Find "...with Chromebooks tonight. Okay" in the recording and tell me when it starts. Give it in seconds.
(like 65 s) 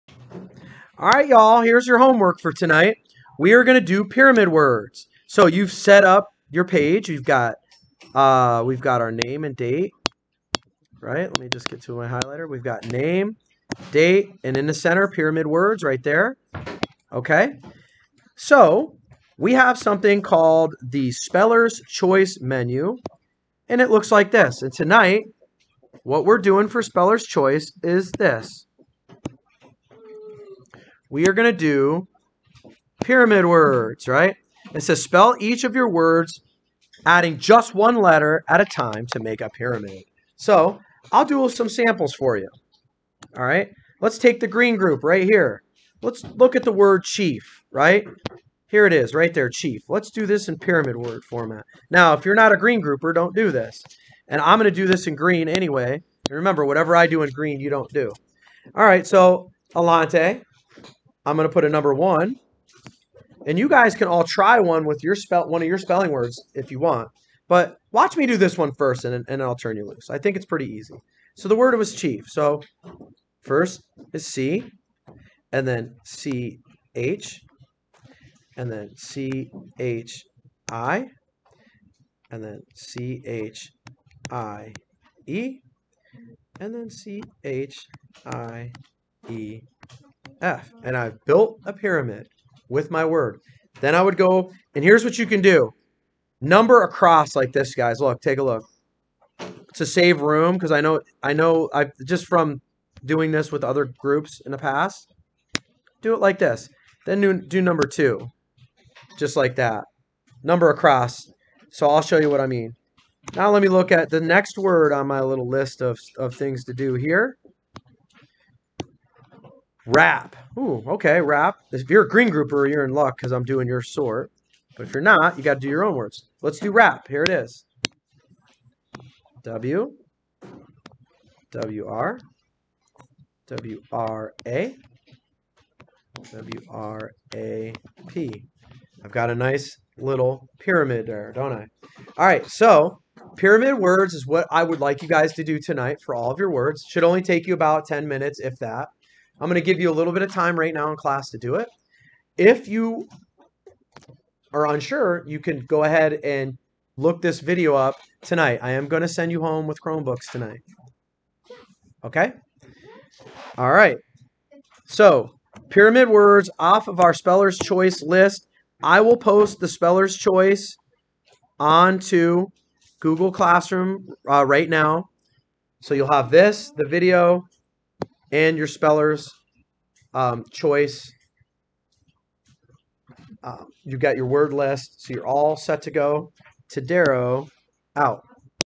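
159 s.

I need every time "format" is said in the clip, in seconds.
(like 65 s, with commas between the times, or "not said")
51 s.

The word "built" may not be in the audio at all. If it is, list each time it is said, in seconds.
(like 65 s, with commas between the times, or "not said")
91 s.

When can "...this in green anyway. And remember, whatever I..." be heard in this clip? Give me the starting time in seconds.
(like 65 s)
54 s.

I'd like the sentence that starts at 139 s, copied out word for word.
I've got a nice little pyramid there, don't I?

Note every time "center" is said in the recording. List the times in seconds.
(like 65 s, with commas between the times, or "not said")
14 s.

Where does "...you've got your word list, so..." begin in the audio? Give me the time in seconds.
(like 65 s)
183 s.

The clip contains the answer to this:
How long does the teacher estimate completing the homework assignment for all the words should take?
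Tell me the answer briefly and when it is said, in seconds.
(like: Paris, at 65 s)
10 minutes, at 147 s.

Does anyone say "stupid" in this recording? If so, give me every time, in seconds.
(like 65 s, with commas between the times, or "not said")
not said.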